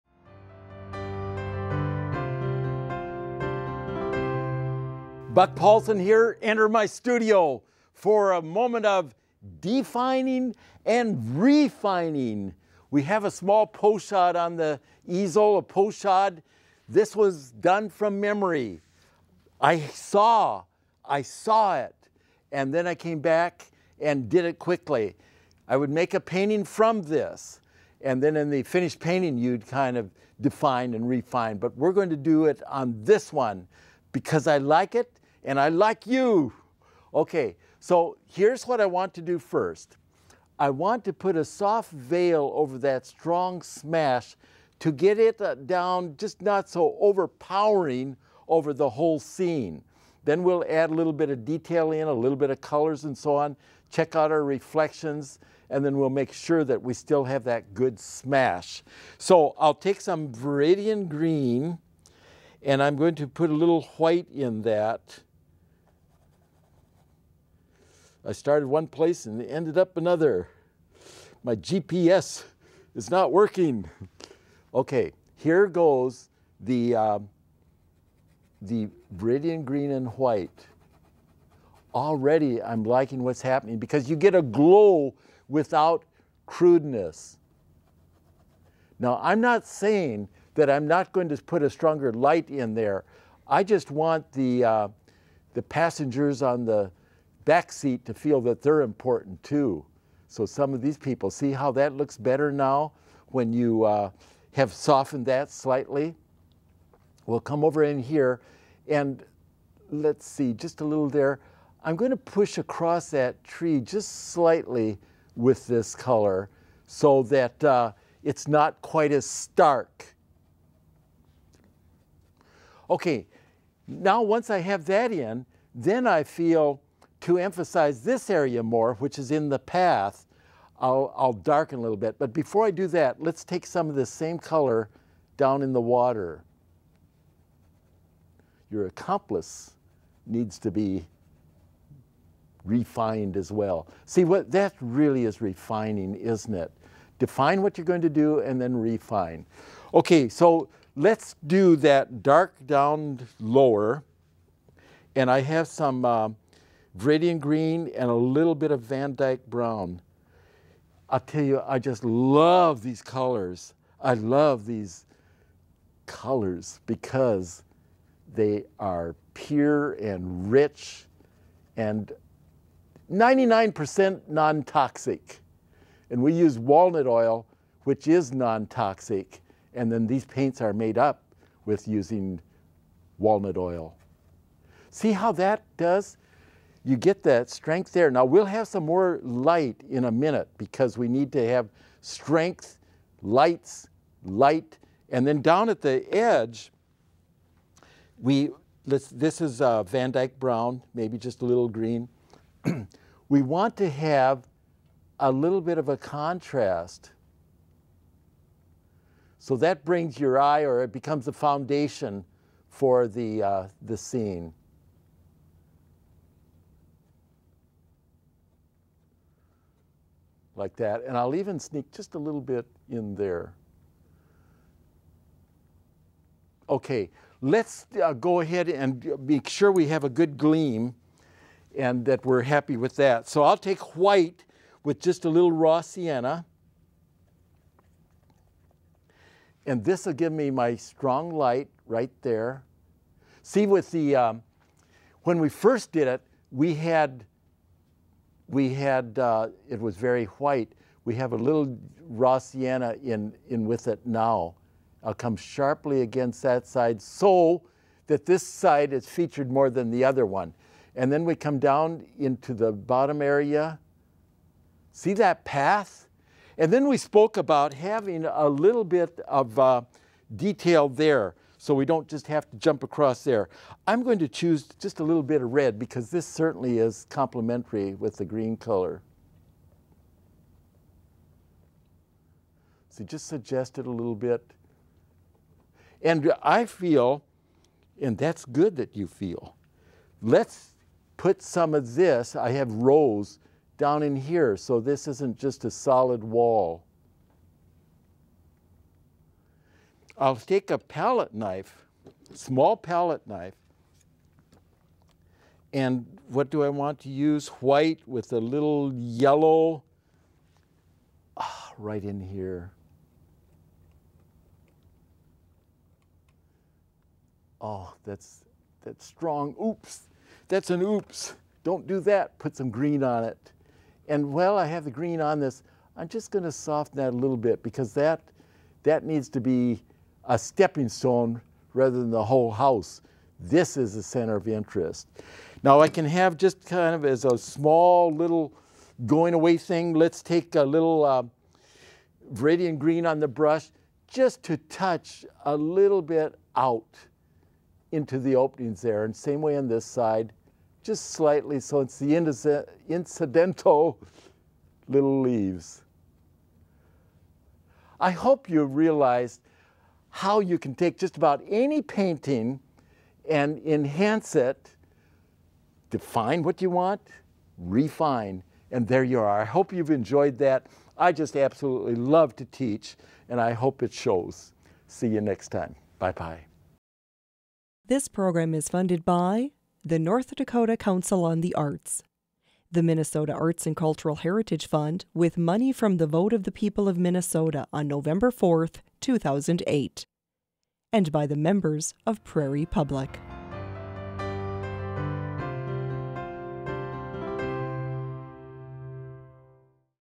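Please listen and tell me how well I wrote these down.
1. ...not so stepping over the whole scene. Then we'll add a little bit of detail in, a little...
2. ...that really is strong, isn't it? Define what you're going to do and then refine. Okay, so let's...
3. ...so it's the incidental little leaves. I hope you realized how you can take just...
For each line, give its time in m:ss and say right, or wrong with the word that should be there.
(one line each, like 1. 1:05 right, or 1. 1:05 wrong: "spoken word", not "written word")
1. 0:46 wrong: "overpowering", not "stepping"
2. 2:24 wrong: "refining", not "strong"
3. 5:51 right.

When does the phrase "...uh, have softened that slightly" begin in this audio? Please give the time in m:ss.
1:43.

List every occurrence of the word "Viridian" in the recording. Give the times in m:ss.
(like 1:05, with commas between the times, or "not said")
1:00, 1:19, 2:36, 5:42.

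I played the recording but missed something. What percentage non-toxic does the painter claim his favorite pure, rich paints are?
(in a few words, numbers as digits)
99%.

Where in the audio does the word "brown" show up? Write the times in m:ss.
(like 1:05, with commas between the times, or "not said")
2:39, 3:20.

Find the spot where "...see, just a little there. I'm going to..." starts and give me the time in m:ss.
1:50.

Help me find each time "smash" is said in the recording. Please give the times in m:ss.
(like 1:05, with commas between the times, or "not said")
0:43, 0:57.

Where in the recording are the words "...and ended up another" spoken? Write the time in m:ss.
1:09.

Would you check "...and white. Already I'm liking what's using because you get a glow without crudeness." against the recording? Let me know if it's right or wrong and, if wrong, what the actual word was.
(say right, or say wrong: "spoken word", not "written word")
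wrong: "happening", not "using".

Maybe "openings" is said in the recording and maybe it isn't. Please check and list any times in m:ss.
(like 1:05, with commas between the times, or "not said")
5:48.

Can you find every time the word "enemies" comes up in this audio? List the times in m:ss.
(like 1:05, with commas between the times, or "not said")
not said.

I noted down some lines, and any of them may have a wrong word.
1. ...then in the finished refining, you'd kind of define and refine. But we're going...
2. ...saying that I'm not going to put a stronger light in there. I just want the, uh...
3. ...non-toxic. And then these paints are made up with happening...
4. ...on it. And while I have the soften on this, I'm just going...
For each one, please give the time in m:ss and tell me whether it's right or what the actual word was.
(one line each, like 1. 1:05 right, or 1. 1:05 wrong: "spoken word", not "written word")
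1. 0:28 wrong: "painting", not "refining"
2. 1:29 right
3. 2:58 wrong: "using", not "happening"
4. 5:23 wrong: "green", not "soften".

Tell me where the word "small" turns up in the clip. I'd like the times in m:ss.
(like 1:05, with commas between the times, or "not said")
0:13, 5:02, 5:37.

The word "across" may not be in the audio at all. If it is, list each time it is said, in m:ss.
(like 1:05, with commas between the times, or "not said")
1:52, 4:32.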